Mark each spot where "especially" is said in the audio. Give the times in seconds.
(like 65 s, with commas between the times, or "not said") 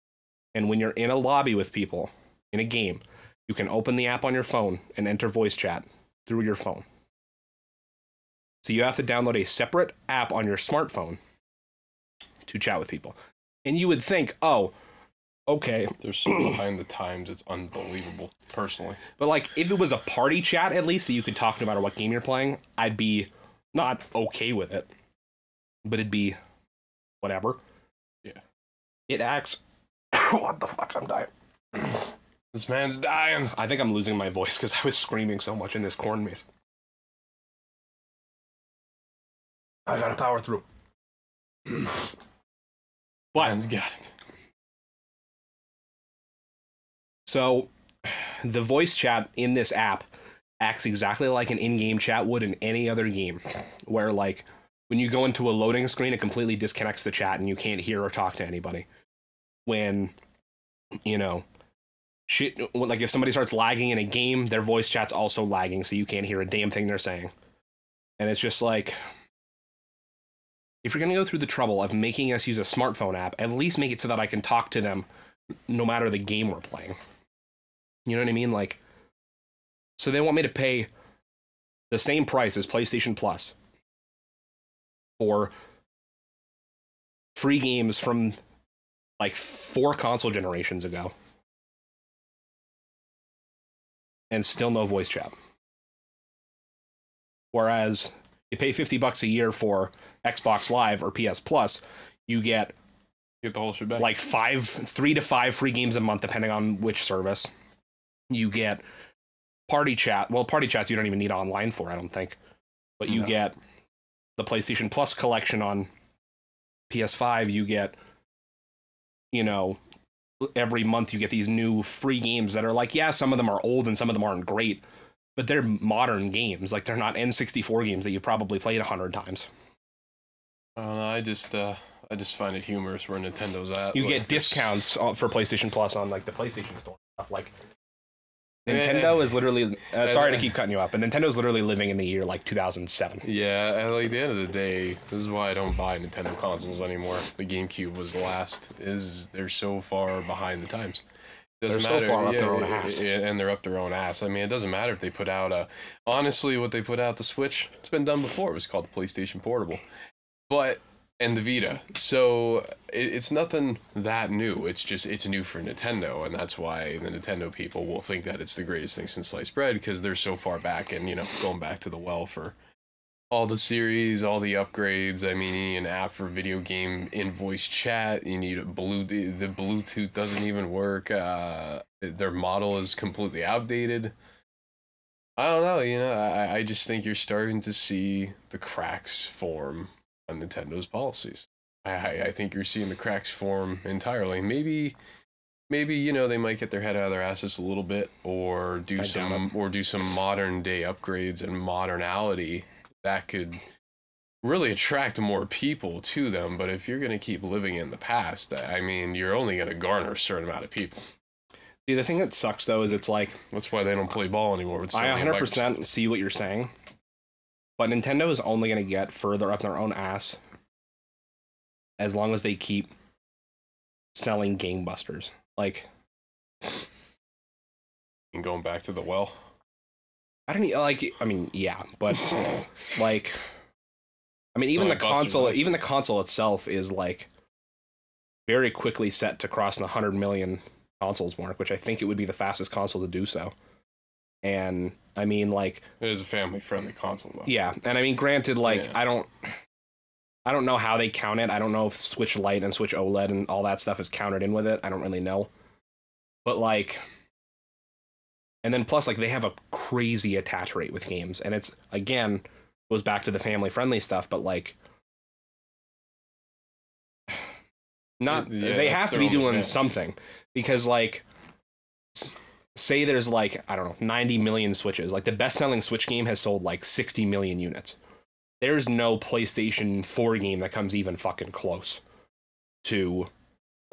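not said.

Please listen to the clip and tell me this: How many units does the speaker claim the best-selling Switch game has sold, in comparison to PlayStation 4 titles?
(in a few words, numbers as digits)
60 million.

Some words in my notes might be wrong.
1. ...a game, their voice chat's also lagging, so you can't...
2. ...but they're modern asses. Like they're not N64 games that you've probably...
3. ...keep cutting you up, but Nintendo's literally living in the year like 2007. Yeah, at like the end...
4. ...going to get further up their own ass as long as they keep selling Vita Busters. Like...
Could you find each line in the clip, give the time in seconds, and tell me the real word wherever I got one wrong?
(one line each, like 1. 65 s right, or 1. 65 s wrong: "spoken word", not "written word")
1. 63 s right
2. 125 s wrong: "games", not "asses"
3. 140 s right
4. 218 s wrong: "Game", not "Vita".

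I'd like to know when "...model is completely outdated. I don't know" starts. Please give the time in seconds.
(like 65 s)
182 s.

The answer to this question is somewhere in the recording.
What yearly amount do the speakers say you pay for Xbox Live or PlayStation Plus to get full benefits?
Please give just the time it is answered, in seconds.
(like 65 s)
98 s.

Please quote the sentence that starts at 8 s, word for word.
So you have to download a separate app on your smartphone to chat with people.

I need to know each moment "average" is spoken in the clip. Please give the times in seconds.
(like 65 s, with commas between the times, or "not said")
not said.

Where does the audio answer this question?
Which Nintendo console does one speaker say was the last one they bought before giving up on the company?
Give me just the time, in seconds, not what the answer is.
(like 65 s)
147 s.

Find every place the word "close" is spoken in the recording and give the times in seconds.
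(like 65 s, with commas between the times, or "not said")
281 s.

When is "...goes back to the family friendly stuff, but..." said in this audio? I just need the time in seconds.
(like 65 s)
262 s.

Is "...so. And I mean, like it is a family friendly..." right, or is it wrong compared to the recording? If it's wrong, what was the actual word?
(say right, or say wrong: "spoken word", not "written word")
right.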